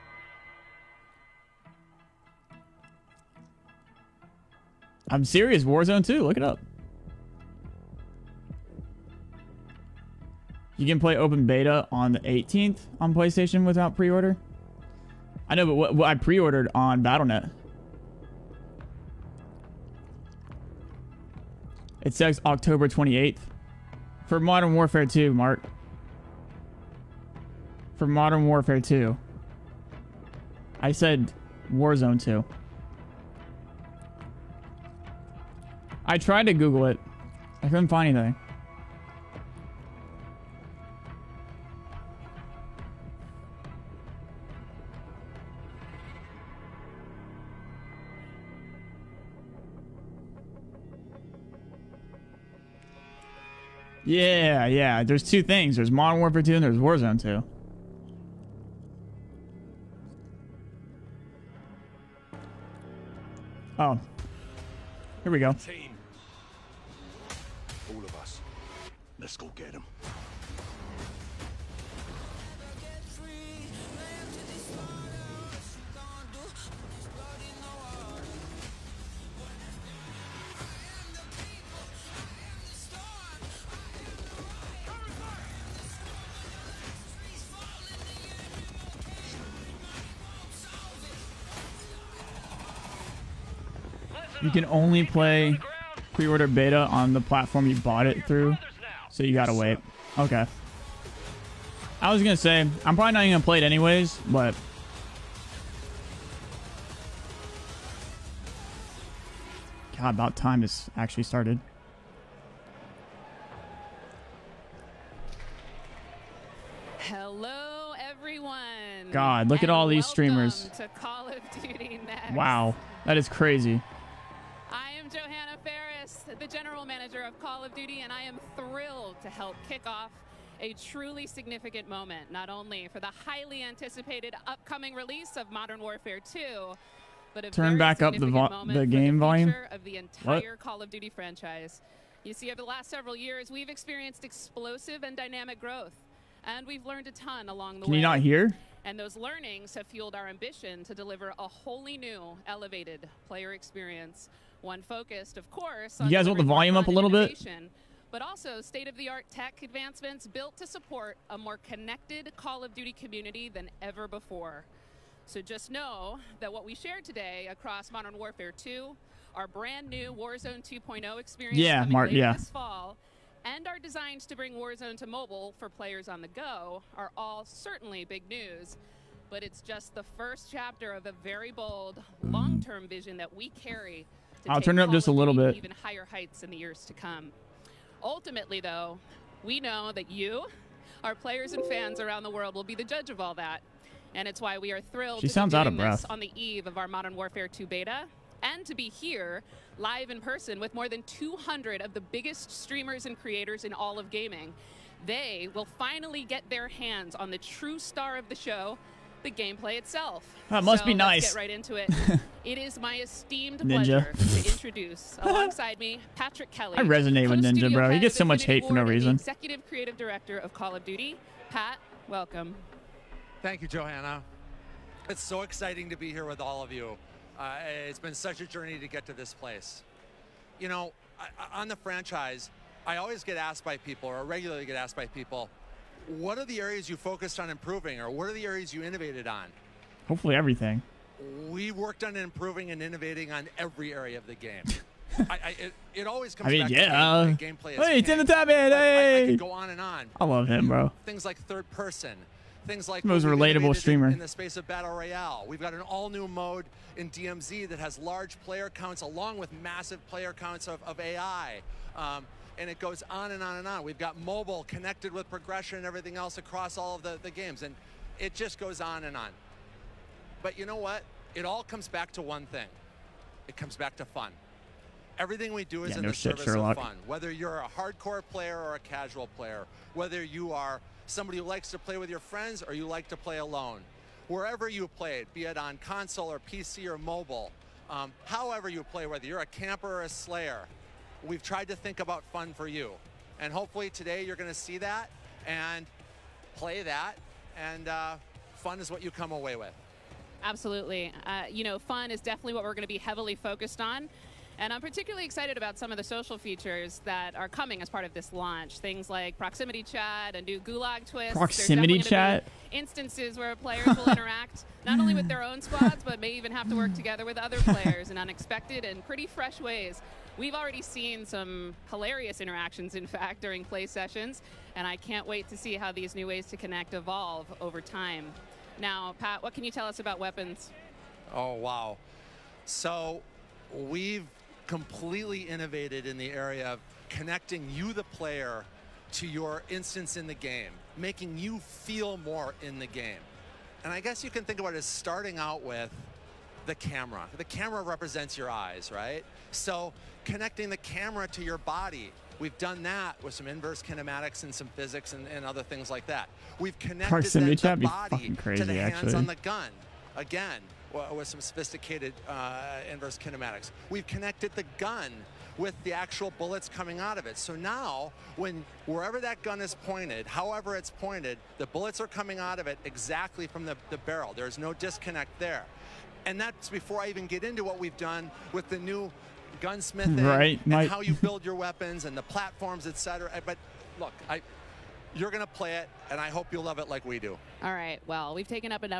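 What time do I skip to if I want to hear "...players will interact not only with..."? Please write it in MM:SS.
05:13.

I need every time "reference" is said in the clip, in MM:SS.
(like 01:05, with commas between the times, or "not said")
not said.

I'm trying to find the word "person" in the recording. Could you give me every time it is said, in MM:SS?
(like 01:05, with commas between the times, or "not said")
03:20, 04:11.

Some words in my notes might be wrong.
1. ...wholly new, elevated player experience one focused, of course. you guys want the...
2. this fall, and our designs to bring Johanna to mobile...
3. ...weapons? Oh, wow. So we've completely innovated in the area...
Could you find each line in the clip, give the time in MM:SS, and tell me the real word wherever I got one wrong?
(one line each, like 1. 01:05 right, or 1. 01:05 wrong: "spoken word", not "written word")
1. 02:31 right
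2. 02:52 wrong: "Warzone", not "Johanna"
3. 05:30 right.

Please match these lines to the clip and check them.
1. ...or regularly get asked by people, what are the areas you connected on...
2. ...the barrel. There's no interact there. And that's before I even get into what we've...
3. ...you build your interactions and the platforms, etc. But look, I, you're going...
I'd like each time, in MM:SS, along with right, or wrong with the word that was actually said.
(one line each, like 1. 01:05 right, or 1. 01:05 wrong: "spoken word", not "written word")
1. 03:54 wrong: "focused", not "connected"
2. 06:13 wrong: "disconnect", not "interact"
3. 06:20 wrong: "weapons", not "interactions".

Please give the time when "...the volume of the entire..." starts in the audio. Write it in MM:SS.
02:19.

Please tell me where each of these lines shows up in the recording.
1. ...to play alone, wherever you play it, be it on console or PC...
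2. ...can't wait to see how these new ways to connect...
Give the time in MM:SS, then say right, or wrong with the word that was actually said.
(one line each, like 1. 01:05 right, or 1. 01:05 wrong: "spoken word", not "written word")
1. 04:43 right
2. 05:24 right.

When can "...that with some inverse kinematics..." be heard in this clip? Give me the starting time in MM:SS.
05:52.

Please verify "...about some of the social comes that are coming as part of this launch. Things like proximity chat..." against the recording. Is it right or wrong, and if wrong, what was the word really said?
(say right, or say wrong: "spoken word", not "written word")
wrong: "features", not "comes".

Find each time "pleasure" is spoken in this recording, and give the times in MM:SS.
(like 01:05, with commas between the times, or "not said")
03:33.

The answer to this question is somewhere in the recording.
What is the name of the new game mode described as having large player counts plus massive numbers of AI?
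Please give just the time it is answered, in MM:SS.
04:17.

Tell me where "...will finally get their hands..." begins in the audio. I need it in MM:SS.
03:25.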